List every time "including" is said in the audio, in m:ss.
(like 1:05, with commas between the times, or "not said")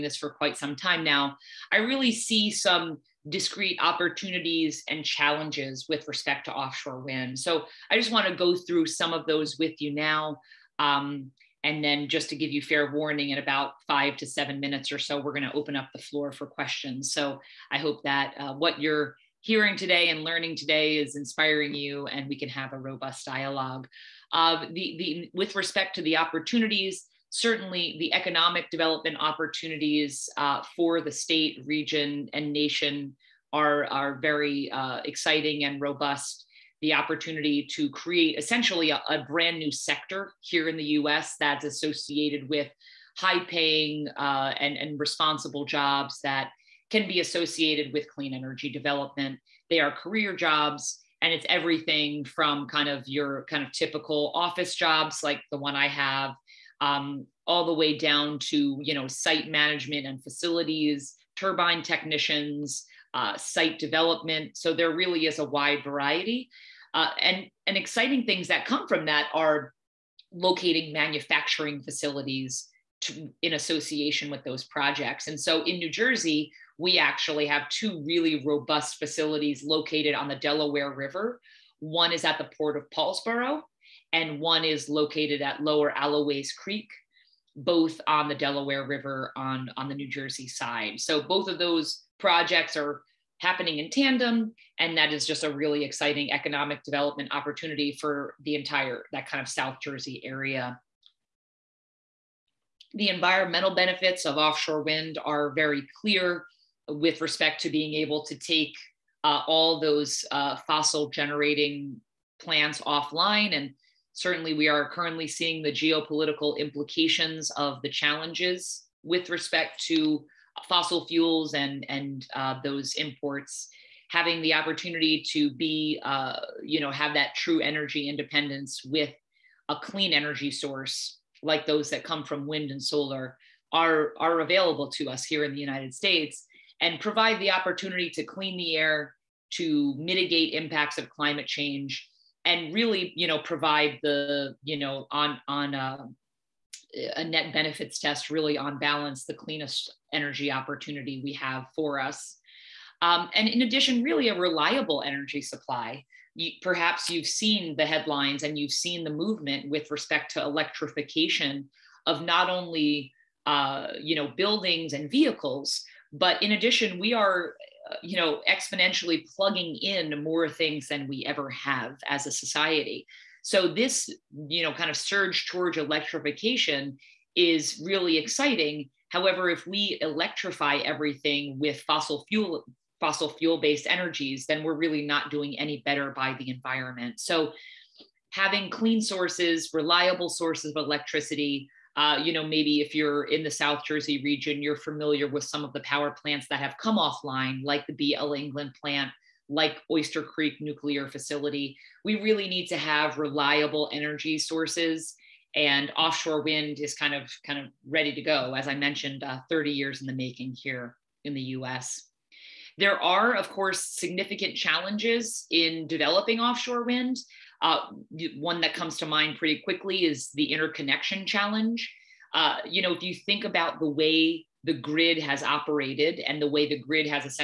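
not said.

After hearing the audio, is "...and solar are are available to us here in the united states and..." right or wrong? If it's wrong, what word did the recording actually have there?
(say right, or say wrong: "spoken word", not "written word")
right.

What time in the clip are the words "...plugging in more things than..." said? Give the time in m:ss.
2:49.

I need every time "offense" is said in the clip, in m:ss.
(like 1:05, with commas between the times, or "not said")
not said.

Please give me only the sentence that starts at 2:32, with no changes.
Um, and in addition, really a reliable energy supply.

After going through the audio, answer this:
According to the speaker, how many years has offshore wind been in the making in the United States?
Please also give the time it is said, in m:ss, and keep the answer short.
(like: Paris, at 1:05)
30, at 3:29.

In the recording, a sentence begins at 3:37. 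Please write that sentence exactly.
Uh, one that comes to mind pretty quickly is the interconnection challenge.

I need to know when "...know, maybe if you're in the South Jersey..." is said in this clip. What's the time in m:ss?
3:12.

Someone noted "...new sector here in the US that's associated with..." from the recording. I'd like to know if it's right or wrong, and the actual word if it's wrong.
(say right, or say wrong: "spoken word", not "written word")
right.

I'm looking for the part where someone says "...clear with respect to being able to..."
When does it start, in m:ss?
1:45.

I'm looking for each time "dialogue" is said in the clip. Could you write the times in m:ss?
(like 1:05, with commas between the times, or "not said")
0:23.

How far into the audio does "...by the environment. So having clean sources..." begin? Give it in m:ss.
3:06.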